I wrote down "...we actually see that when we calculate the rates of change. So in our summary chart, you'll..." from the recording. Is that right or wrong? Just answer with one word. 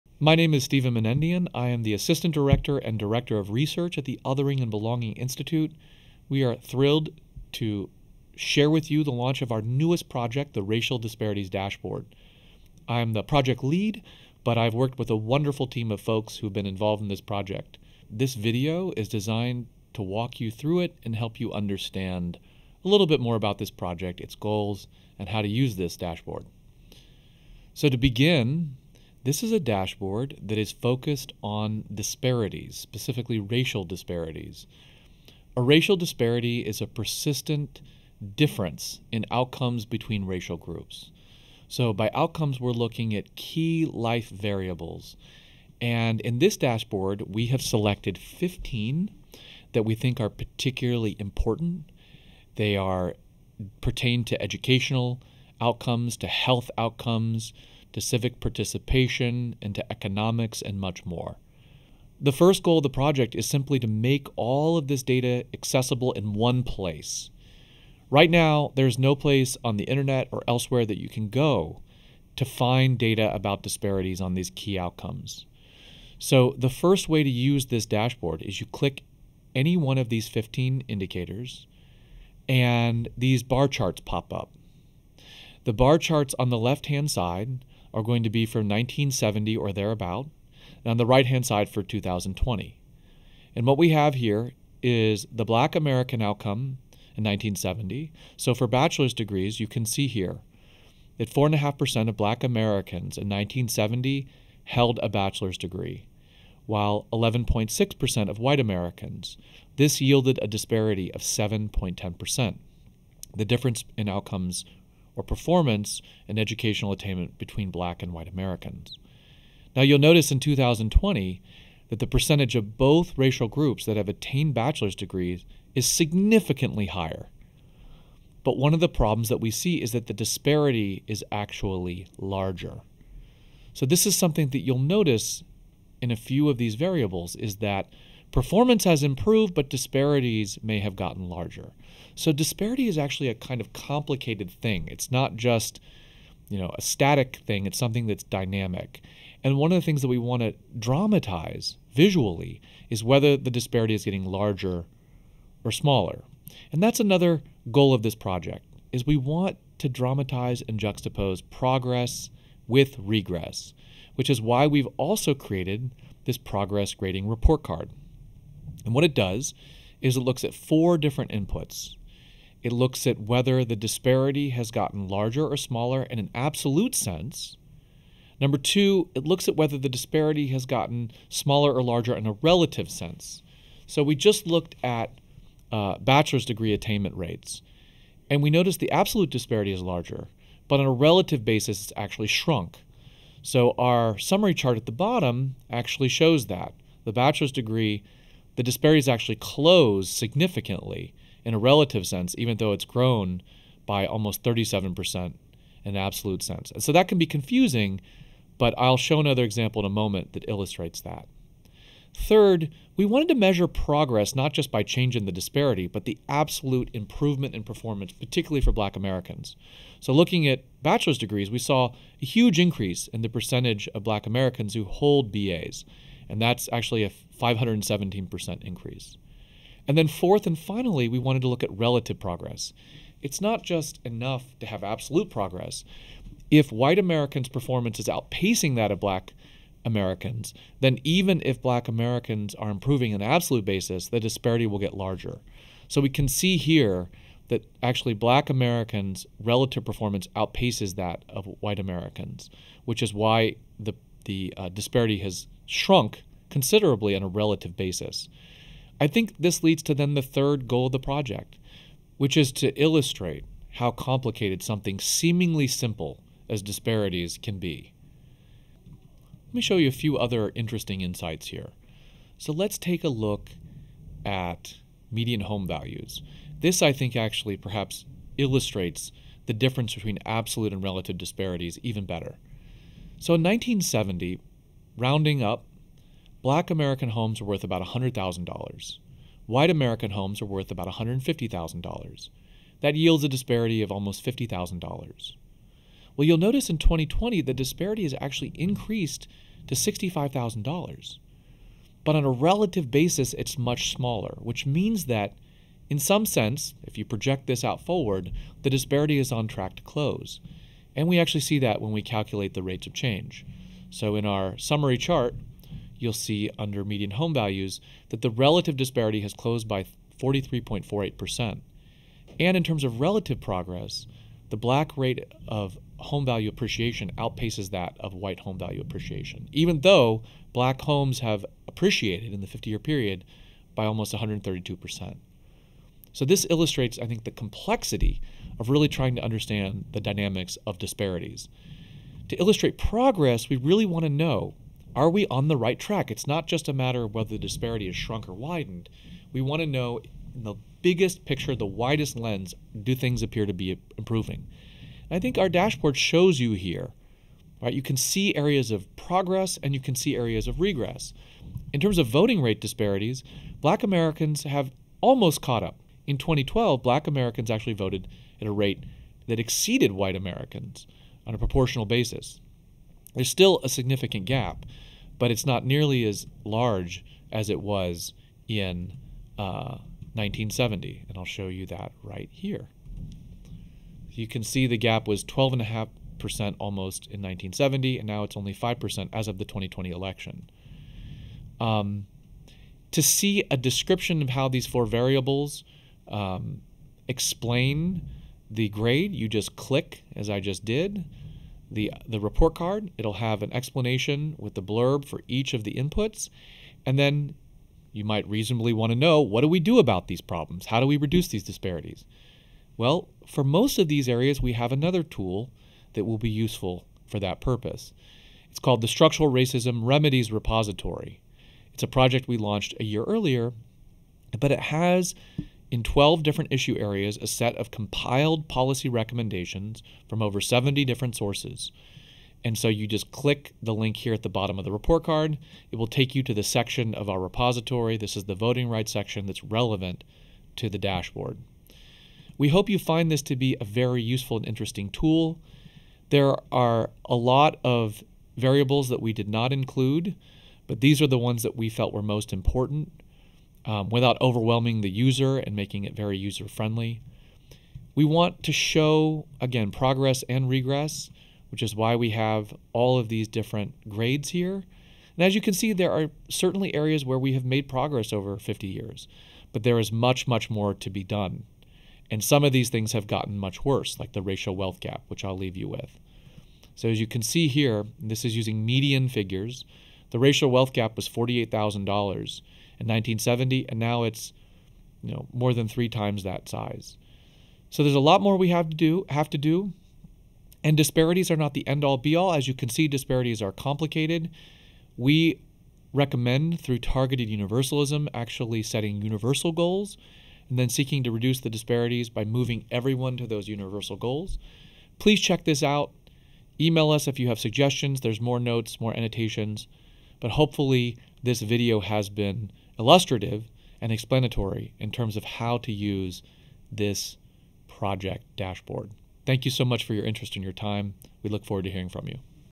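right.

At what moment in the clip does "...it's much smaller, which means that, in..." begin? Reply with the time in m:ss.
5:03.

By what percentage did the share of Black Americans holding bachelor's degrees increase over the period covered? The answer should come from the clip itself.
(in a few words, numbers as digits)
517%.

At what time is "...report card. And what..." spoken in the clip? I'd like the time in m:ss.
2:47.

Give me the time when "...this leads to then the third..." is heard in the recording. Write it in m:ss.
4:19.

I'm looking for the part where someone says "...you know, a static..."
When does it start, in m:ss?
2:26.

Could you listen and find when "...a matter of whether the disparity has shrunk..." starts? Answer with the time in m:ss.
5:46.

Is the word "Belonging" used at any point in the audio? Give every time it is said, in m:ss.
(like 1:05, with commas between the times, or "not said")
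0:04.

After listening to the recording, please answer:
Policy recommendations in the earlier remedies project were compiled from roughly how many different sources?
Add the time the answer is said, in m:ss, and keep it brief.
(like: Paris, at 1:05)
over 70, at 7:10.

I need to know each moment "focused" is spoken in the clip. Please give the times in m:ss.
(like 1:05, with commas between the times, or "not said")
0:30.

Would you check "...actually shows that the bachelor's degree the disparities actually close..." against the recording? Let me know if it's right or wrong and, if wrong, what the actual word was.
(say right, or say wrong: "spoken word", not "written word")
right.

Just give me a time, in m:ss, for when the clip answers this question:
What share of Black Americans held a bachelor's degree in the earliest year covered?
1:41.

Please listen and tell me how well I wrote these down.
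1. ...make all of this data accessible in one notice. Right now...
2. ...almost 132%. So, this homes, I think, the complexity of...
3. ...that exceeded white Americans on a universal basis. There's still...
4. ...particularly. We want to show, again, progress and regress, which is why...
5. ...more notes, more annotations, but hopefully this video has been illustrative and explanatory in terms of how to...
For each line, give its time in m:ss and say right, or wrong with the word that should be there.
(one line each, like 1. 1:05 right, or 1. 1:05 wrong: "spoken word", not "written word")
1. 1:03 wrong: "place", not "notice"
2. 5:33 wrong: "illustrates", not "homes"
3. 6:09 wrong: "proportional", not "universal"
4. 7:36 wrong: "friendly", not "particularly"
5. 8:28 right.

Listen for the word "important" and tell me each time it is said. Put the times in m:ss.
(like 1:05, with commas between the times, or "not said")
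0:51, 7:32.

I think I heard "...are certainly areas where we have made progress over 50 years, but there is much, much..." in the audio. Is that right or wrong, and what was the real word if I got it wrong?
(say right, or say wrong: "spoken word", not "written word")
right.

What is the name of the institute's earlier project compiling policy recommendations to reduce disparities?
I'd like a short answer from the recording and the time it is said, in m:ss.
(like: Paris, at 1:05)
Structural Racism Remedies Repository, at 6:58.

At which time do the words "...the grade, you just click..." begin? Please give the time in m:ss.
6:38.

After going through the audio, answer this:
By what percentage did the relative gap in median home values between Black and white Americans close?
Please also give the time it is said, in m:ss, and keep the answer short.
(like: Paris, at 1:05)
43.48%, at 5:20.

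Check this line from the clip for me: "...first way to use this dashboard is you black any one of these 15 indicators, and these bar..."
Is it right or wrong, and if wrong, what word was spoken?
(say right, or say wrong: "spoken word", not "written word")
wrong: "click", not "black".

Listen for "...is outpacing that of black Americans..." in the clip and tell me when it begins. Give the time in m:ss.
3:57.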